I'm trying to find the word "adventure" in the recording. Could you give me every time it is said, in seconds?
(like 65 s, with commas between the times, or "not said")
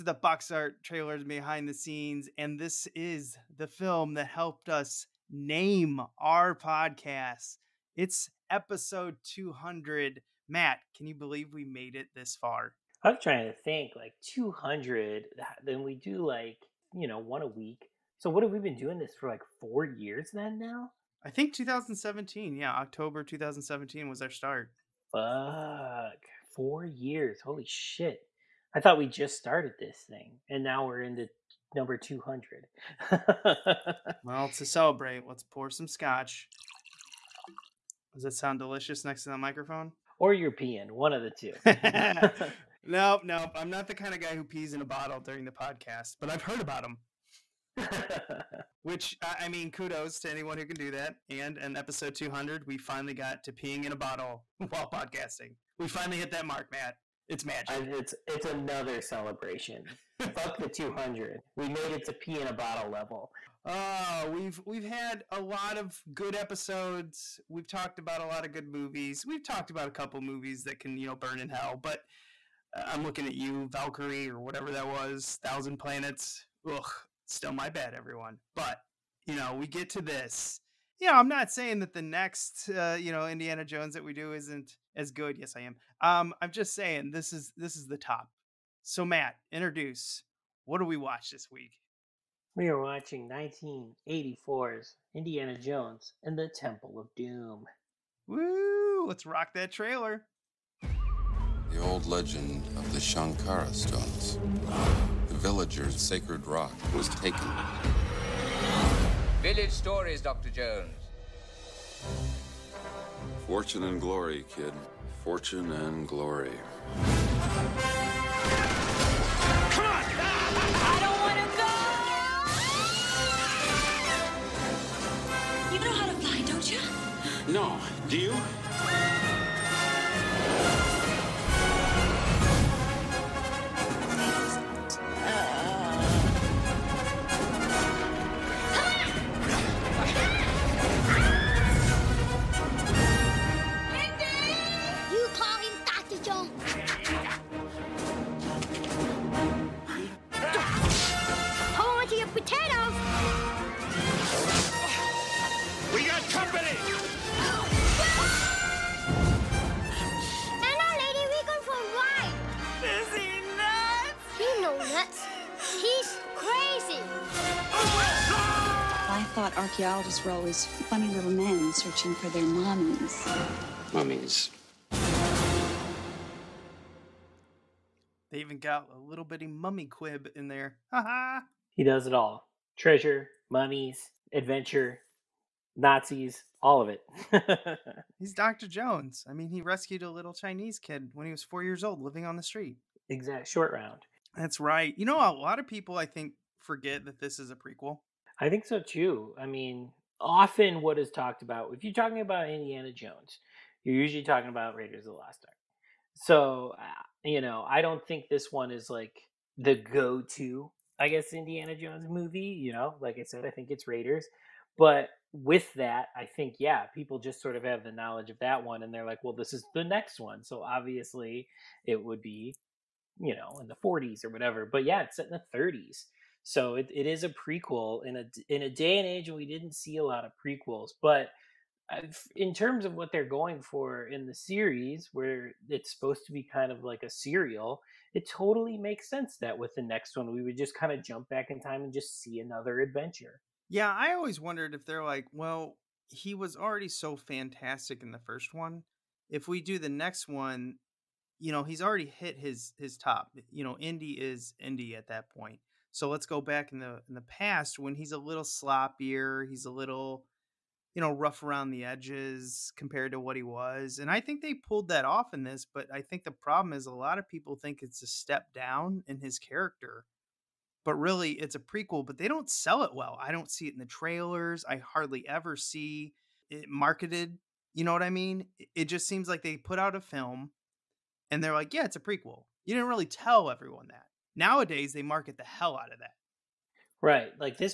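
184 s, 242 s.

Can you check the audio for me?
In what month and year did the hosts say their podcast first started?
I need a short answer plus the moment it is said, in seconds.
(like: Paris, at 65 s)
October 2017, at 22 s.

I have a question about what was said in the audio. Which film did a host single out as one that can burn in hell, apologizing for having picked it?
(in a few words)
Valkyrie.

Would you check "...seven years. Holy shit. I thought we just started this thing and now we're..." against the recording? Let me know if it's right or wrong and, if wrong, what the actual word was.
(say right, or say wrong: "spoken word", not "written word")
wrong: "four", not "seven".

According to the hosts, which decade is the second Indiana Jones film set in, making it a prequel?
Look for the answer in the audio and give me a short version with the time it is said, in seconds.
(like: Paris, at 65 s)
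the 30s, at 225 s.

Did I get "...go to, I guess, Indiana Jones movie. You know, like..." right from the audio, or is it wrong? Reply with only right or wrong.
right.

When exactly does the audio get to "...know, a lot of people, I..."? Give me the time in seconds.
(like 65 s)
195 s.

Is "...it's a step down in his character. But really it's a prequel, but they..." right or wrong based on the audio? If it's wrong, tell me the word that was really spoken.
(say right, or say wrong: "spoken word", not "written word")
right.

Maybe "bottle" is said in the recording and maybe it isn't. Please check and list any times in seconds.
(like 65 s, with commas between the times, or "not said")
44 s, 53 s, 62 s.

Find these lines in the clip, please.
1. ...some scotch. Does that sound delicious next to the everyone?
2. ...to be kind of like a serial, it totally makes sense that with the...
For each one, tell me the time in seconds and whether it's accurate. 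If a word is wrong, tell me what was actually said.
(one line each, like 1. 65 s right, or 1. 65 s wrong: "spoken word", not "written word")
1. 35 s wrong: "microphone", not "everyone"
2. 236 s right.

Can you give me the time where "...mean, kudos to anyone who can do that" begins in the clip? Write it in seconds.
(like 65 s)
49 s.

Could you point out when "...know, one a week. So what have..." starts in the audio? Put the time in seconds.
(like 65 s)
17 s.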